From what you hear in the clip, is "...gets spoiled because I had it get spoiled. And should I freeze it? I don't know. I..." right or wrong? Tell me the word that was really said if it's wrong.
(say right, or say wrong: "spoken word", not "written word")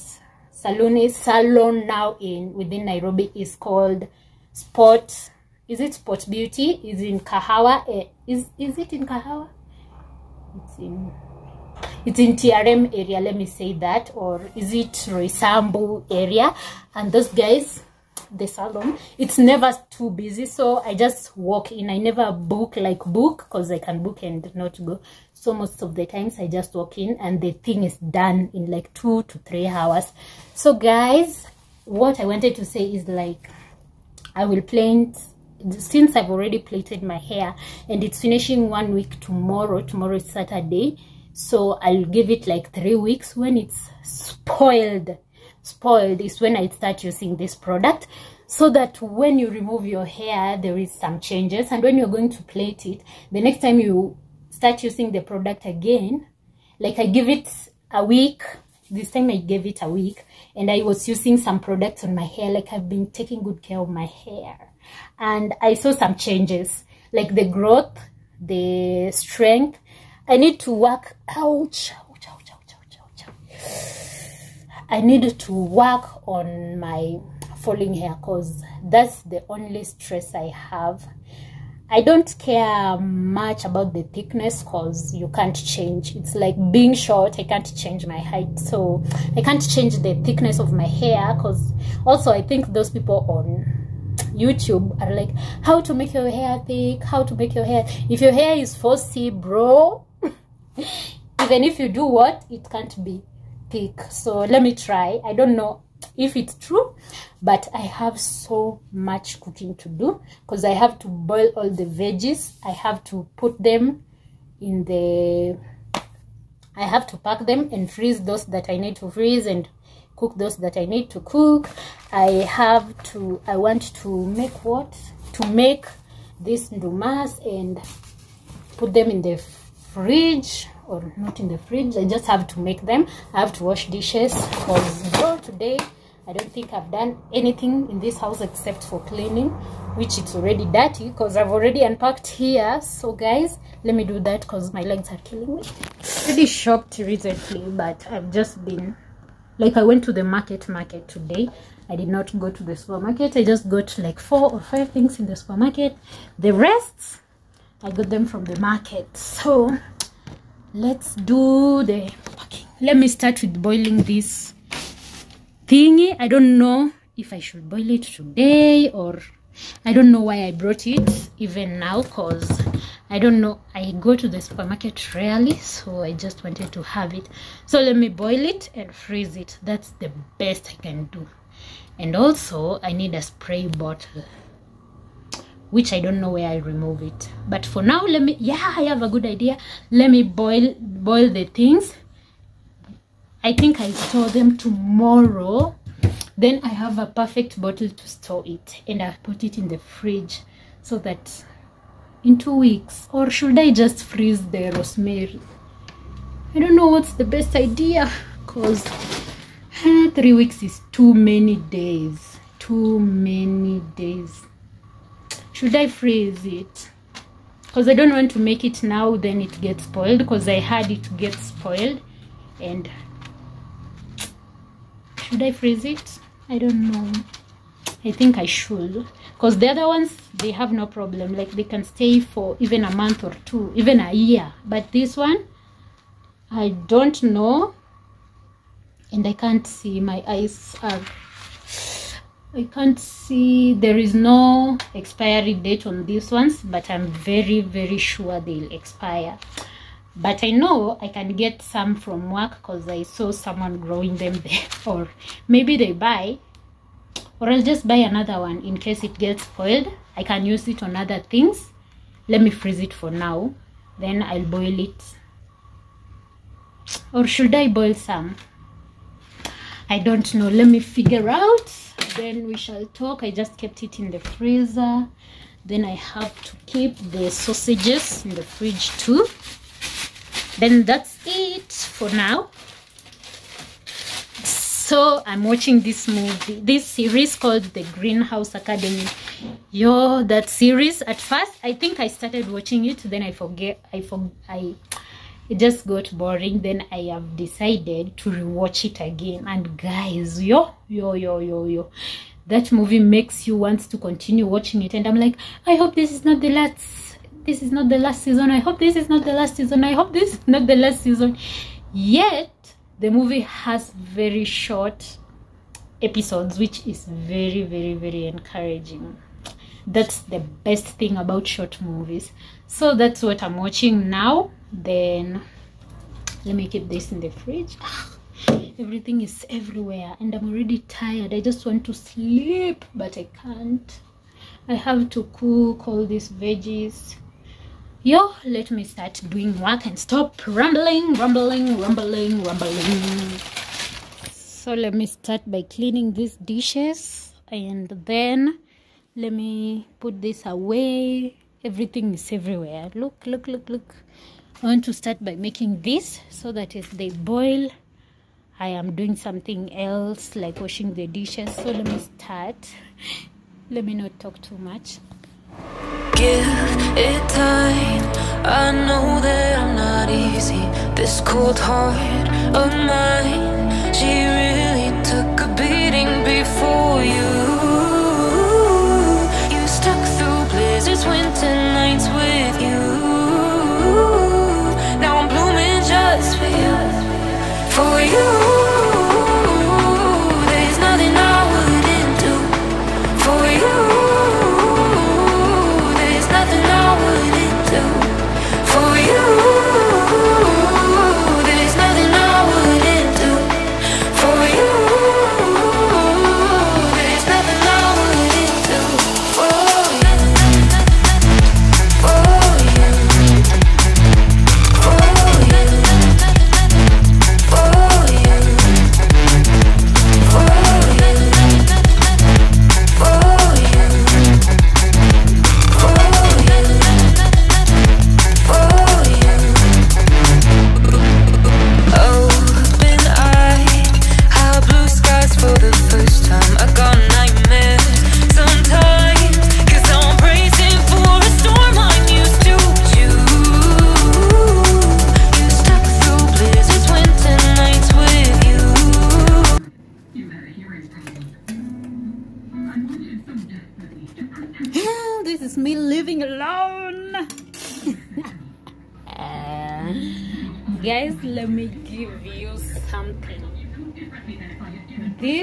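right.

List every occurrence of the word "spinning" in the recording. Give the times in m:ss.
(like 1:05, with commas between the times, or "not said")
not said.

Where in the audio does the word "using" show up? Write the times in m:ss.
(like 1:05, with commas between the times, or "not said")
0:47, 0:54, 1:01.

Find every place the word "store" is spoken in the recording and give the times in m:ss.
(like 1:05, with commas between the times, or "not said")
3:13, 3:18.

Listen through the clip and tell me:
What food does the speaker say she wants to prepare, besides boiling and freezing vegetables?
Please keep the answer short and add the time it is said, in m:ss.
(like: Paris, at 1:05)
Ndumas, at 2:06.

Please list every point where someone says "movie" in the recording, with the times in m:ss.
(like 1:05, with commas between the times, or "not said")
4:46, 5:02, 5:13, 5:21.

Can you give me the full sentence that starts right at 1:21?
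I don't care much about the thickness because you can't change.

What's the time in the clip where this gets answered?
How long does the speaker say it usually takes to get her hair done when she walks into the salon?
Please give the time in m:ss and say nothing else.
0:28.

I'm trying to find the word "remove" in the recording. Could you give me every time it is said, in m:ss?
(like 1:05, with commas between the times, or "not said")
0:49, 3:06.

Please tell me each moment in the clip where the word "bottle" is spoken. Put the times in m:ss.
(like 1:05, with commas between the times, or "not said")
3:03, 3:17.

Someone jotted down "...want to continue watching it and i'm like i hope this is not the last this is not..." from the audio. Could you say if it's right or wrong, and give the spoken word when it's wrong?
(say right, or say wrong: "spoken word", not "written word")
right.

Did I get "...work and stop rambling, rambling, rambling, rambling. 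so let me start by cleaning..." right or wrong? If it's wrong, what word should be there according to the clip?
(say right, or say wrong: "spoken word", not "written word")
right.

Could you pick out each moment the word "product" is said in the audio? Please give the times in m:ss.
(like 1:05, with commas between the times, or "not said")
0:47, 0:55, 1:01.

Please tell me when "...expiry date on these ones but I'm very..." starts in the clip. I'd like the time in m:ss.
4:04.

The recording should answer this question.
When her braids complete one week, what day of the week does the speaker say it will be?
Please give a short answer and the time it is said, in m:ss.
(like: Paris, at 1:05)
Saturday, at 0:39.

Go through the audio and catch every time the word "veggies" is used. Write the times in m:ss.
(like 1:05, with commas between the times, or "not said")
1:51, 5:36.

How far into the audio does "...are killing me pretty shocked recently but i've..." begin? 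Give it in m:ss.
2:25.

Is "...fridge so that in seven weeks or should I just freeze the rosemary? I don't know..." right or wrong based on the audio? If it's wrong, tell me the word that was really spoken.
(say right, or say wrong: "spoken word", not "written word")
wrong: "two", not "seven".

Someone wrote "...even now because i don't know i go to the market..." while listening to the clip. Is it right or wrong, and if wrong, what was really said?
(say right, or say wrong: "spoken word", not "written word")
wrong: "supermarket", not "market".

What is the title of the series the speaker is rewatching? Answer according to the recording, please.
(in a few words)
Greenhouse Academy.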